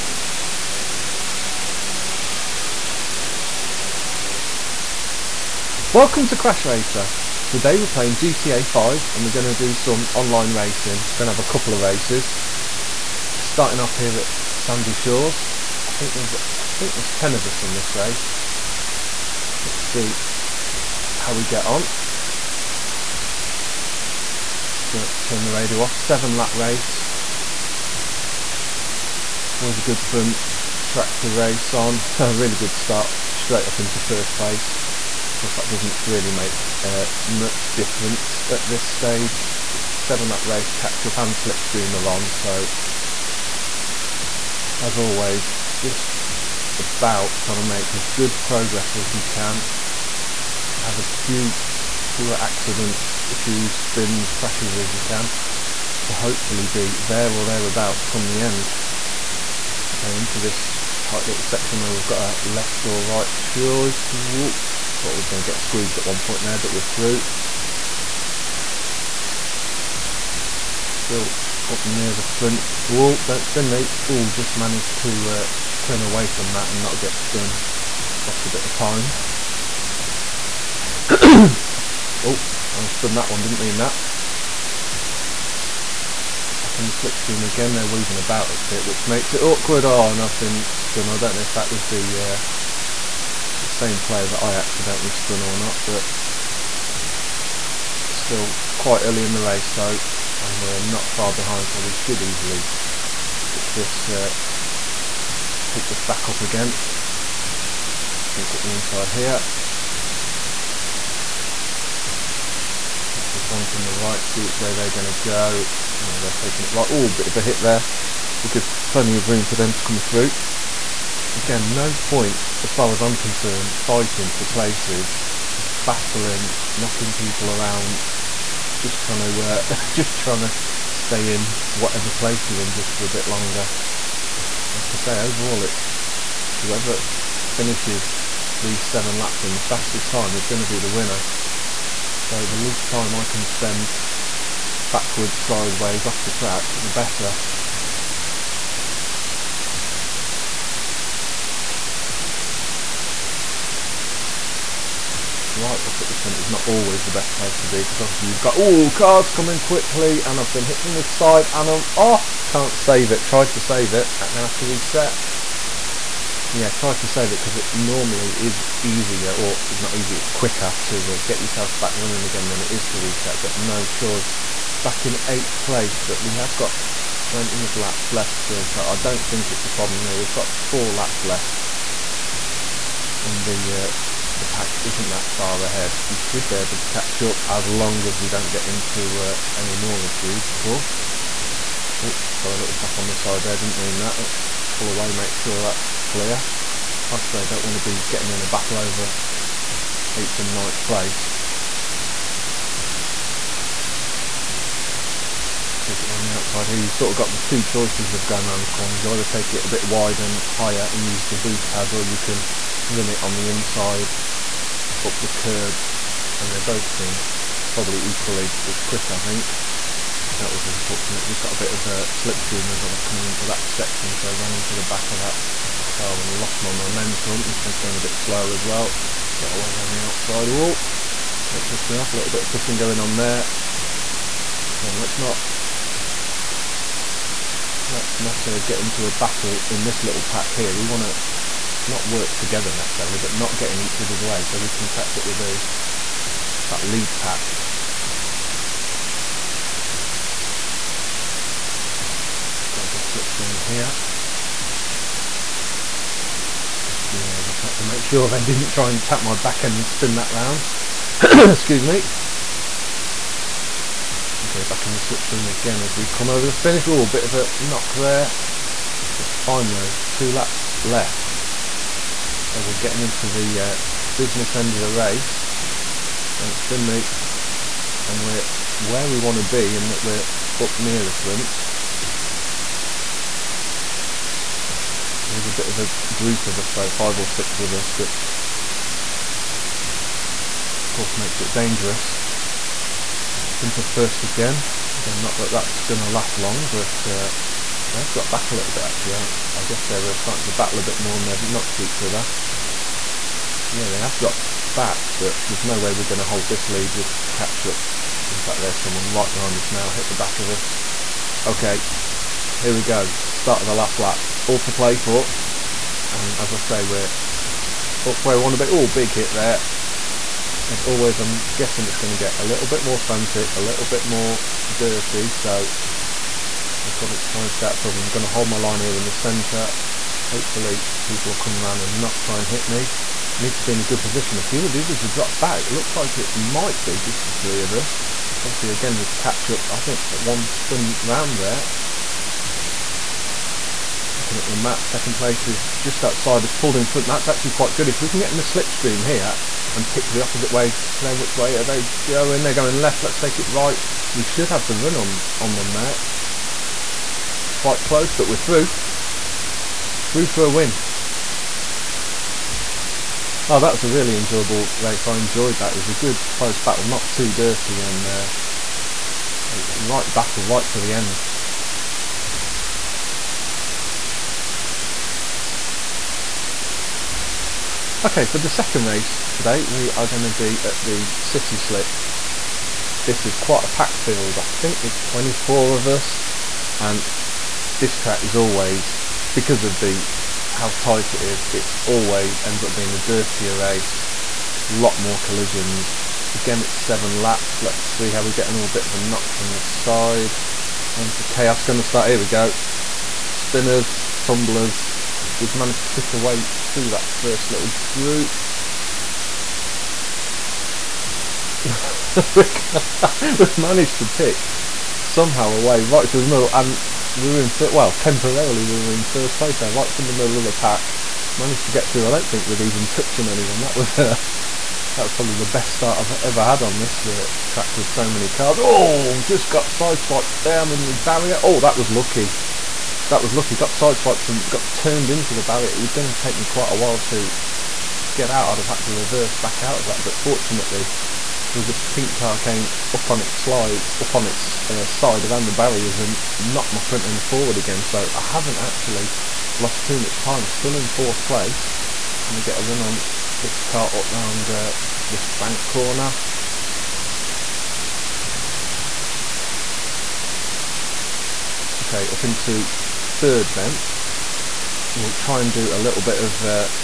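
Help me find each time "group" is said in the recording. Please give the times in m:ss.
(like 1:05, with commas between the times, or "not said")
4:46, 6:47.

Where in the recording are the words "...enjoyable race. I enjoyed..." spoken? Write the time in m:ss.
6:04.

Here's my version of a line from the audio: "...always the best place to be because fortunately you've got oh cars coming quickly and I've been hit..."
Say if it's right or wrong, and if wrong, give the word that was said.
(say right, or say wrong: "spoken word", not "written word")
wrong: "obviously", not "fortunately".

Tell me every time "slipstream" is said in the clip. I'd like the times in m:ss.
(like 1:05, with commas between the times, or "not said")
0:41, 1:26, 3:42, 4:13, 4:25, 5:48.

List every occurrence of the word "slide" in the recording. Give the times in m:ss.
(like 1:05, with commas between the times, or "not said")
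7:23.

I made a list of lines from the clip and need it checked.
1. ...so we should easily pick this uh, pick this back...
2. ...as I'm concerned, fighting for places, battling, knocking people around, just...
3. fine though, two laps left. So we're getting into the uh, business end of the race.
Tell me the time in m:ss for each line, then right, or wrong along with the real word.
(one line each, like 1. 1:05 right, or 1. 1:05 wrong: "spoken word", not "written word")
1. 1:41 right
2. 2:02 right
3. 4:29 right.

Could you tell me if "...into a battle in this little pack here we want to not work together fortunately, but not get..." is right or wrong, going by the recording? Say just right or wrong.
wrong.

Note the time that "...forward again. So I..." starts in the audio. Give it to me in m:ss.
7:27.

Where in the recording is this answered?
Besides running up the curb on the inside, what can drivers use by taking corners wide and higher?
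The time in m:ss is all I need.
3:31.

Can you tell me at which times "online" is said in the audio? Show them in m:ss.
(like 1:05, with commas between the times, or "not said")
0:10.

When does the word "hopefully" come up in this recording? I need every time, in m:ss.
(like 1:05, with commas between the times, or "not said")
0:56, 5:30.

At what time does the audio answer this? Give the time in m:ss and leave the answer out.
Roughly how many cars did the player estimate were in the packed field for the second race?
6:25.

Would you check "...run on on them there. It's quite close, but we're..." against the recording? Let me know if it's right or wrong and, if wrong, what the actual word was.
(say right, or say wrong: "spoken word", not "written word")
right.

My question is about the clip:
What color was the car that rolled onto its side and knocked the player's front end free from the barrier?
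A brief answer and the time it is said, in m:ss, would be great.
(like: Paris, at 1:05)
pink, at 7:21.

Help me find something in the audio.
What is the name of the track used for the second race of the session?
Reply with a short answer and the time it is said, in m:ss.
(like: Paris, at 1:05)
City Slick, at 6:21.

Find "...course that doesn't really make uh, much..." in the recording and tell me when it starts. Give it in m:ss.
0:35.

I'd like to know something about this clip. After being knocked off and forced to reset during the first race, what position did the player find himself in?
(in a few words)
8th.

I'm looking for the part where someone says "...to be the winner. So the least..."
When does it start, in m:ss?
2:20.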